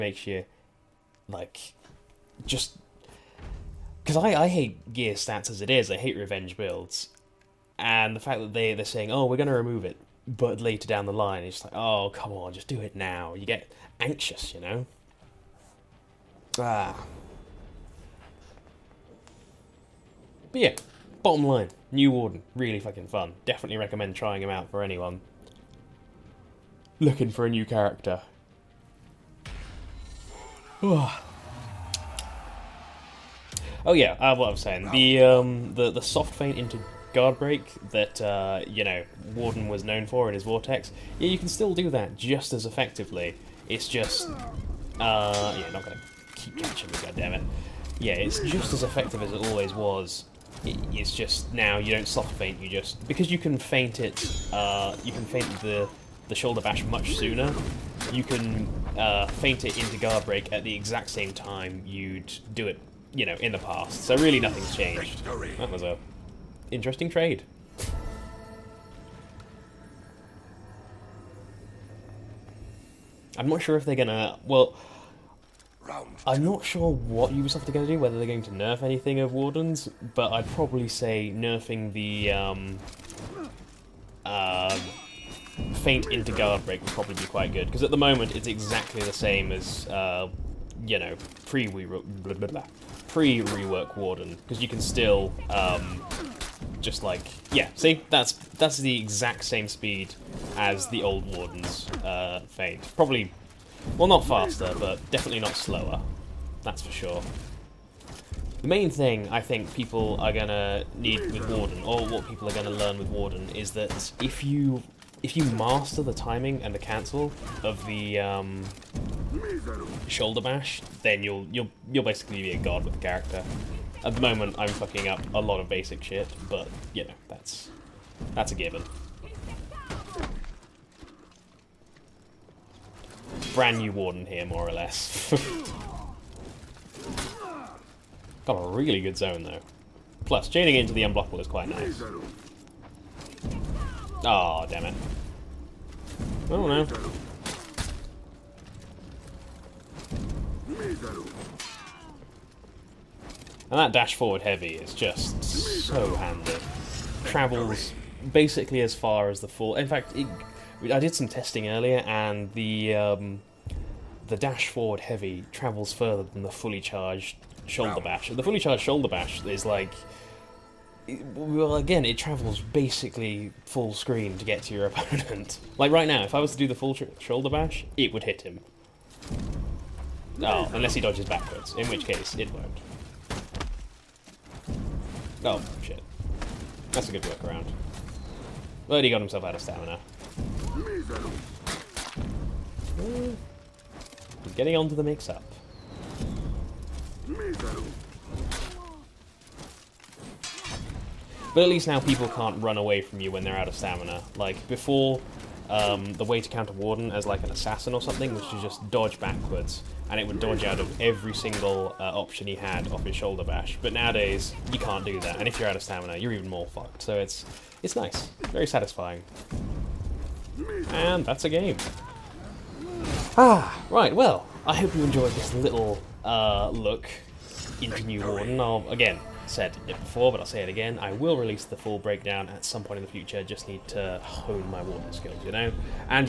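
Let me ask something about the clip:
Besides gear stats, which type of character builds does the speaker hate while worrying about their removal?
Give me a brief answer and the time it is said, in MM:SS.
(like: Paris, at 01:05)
Revenge builds, at 00:06.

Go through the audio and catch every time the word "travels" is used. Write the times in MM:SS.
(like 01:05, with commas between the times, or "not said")
02:37, 02:45, 02:52.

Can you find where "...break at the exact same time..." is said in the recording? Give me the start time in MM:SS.
01:00.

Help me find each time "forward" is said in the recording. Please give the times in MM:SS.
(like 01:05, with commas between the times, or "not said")
02:34, 02:44.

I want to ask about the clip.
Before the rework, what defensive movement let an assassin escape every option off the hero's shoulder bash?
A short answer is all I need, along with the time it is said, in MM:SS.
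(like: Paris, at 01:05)
Dodge backwards, at 03:28.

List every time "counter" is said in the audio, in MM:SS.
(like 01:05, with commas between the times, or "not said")
03:26.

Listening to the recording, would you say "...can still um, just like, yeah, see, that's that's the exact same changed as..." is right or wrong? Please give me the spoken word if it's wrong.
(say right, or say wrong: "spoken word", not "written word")
wrong: "speed", not "changed".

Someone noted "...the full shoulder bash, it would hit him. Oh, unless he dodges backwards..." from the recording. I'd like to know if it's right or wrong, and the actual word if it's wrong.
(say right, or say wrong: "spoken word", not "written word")
right.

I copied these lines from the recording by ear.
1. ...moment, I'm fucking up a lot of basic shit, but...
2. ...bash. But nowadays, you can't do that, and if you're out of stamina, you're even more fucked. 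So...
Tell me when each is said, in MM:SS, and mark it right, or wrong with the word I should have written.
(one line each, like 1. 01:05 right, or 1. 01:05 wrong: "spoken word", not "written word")
1. 02:04 right
2. 03:33 right.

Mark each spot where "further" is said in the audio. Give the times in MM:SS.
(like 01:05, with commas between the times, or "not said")
02:45.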